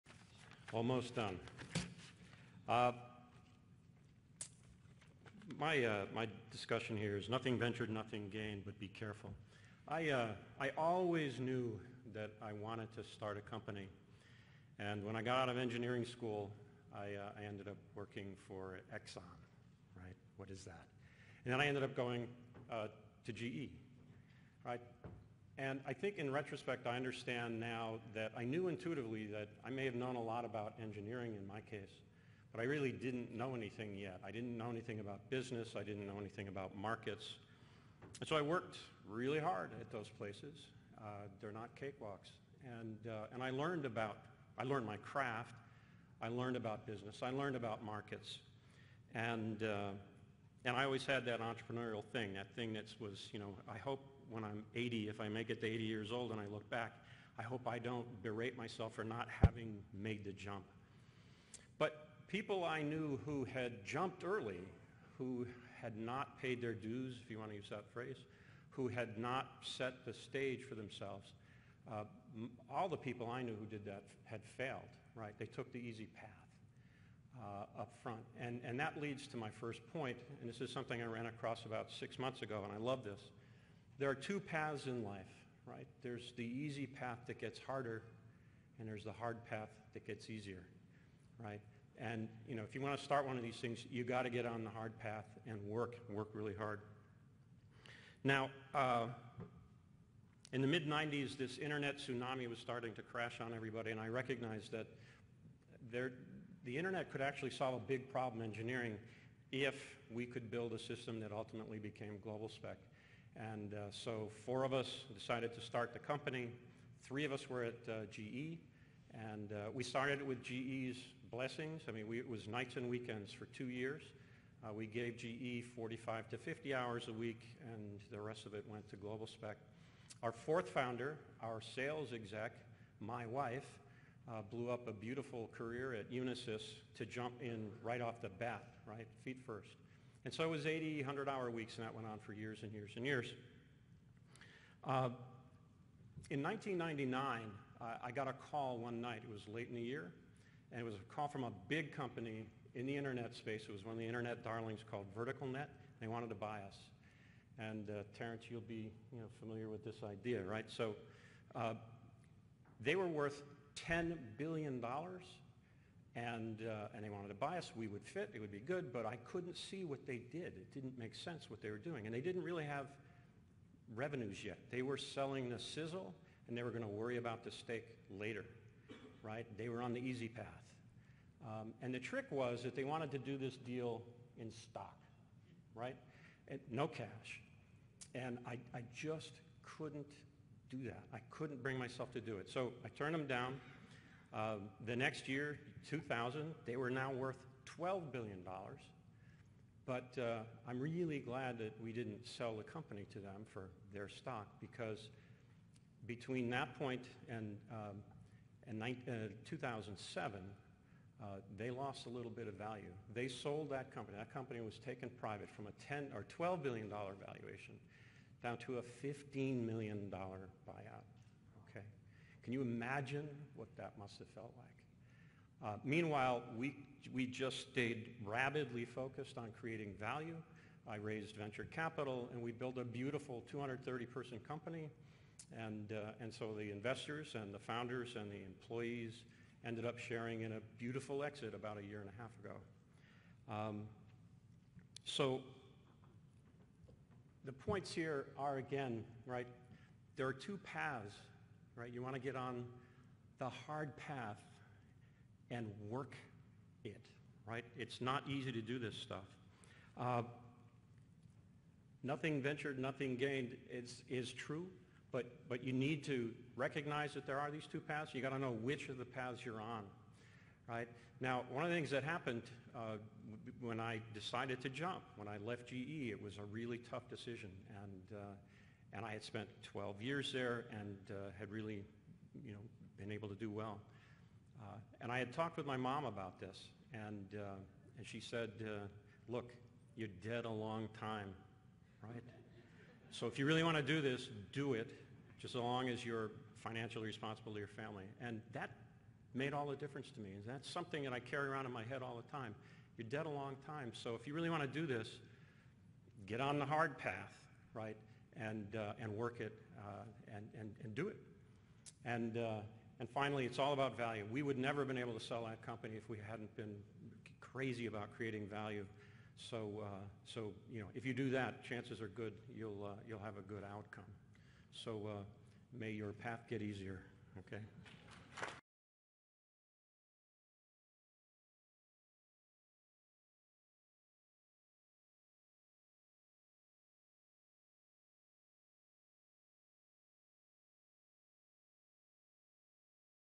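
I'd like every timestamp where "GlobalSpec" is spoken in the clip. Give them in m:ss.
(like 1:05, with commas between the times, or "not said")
1:52, 2:08.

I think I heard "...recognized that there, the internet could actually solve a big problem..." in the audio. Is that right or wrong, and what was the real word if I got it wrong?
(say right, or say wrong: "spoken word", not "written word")
right.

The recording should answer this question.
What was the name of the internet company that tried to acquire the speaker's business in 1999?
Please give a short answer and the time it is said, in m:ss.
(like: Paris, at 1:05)
VerticalNet, at 2:35.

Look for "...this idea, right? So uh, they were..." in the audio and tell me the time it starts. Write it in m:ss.
2:39.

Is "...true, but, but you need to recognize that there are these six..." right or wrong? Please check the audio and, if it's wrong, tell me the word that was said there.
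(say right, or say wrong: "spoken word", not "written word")
wrong: "two", not "six".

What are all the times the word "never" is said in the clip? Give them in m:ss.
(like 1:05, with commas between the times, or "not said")
5:14.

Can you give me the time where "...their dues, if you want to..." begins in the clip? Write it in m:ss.
1:06.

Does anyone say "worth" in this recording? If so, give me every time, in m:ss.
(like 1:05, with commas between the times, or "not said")
2:43, 3:17.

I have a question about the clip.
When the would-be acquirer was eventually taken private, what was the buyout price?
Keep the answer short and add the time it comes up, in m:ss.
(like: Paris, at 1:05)
$15 million, at 3:39.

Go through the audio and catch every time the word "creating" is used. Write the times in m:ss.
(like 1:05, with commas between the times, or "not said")
3:49, 5:18.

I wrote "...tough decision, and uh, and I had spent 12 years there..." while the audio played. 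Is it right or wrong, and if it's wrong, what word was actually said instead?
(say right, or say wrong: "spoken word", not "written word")
right.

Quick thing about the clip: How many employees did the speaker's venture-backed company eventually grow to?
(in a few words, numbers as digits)
230.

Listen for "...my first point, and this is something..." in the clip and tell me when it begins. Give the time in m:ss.
1:19.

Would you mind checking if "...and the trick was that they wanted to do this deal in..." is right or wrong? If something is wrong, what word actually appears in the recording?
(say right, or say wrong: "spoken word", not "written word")
right.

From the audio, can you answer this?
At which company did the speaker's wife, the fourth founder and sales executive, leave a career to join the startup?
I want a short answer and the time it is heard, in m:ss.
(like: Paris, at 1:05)
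Unisys, at 2:16.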